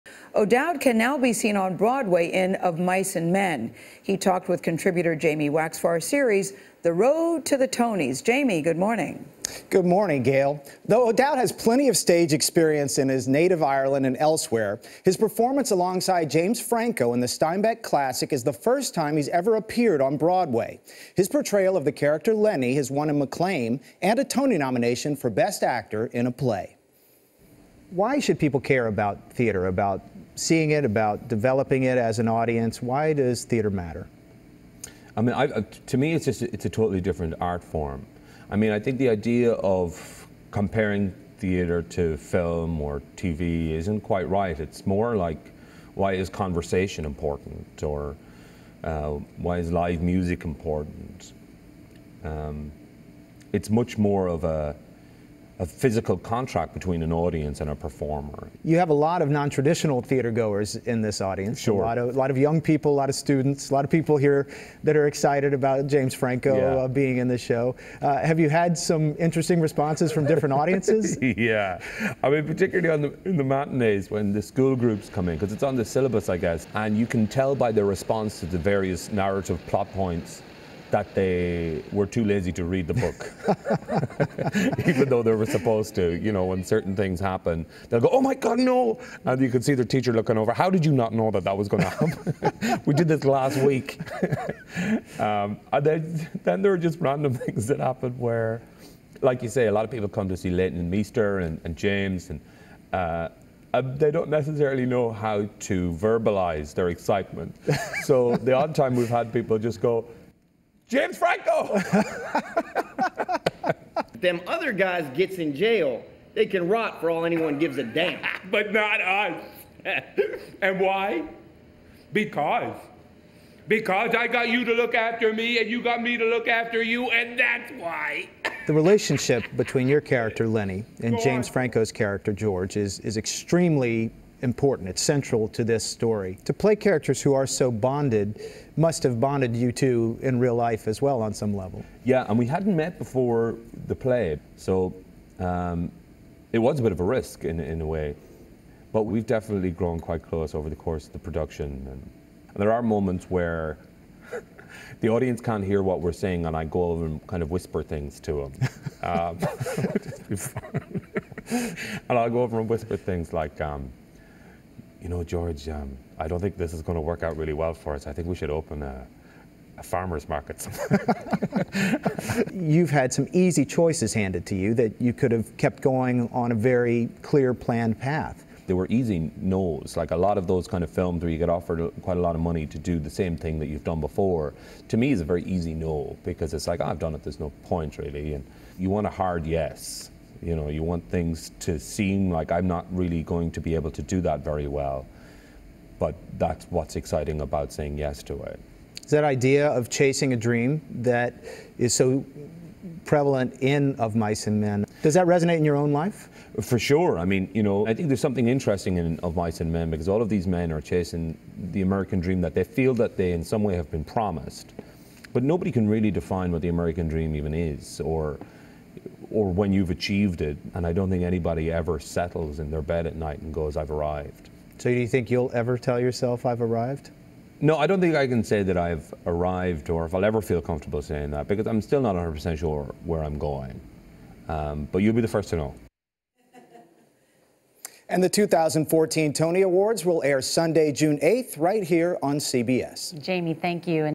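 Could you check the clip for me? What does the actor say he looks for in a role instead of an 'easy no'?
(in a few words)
A hard yes.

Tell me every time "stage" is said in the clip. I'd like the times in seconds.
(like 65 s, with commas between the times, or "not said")
11 s.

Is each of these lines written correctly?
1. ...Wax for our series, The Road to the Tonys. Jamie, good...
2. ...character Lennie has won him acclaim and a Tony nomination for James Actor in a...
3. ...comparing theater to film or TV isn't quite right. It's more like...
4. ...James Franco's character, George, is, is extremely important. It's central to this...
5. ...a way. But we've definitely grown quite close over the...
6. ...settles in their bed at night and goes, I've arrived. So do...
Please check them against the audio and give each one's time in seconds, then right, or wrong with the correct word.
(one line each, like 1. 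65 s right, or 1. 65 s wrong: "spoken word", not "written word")
1. 5 s right
2. 21 s wrong: "Best", not "James"
3. 40 s right
4. 131 s right
5. 147 s right
6. 221 s right.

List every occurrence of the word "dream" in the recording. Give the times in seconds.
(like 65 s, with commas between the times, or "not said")
200 s, 212 s, 217 s.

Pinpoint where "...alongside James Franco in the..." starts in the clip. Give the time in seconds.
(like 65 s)
15 s.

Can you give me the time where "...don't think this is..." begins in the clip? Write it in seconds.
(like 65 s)
166 s.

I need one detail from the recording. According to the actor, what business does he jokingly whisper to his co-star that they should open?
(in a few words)
A farmer's market.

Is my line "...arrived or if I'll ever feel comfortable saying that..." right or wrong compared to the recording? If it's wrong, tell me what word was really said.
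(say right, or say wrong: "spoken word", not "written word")
right.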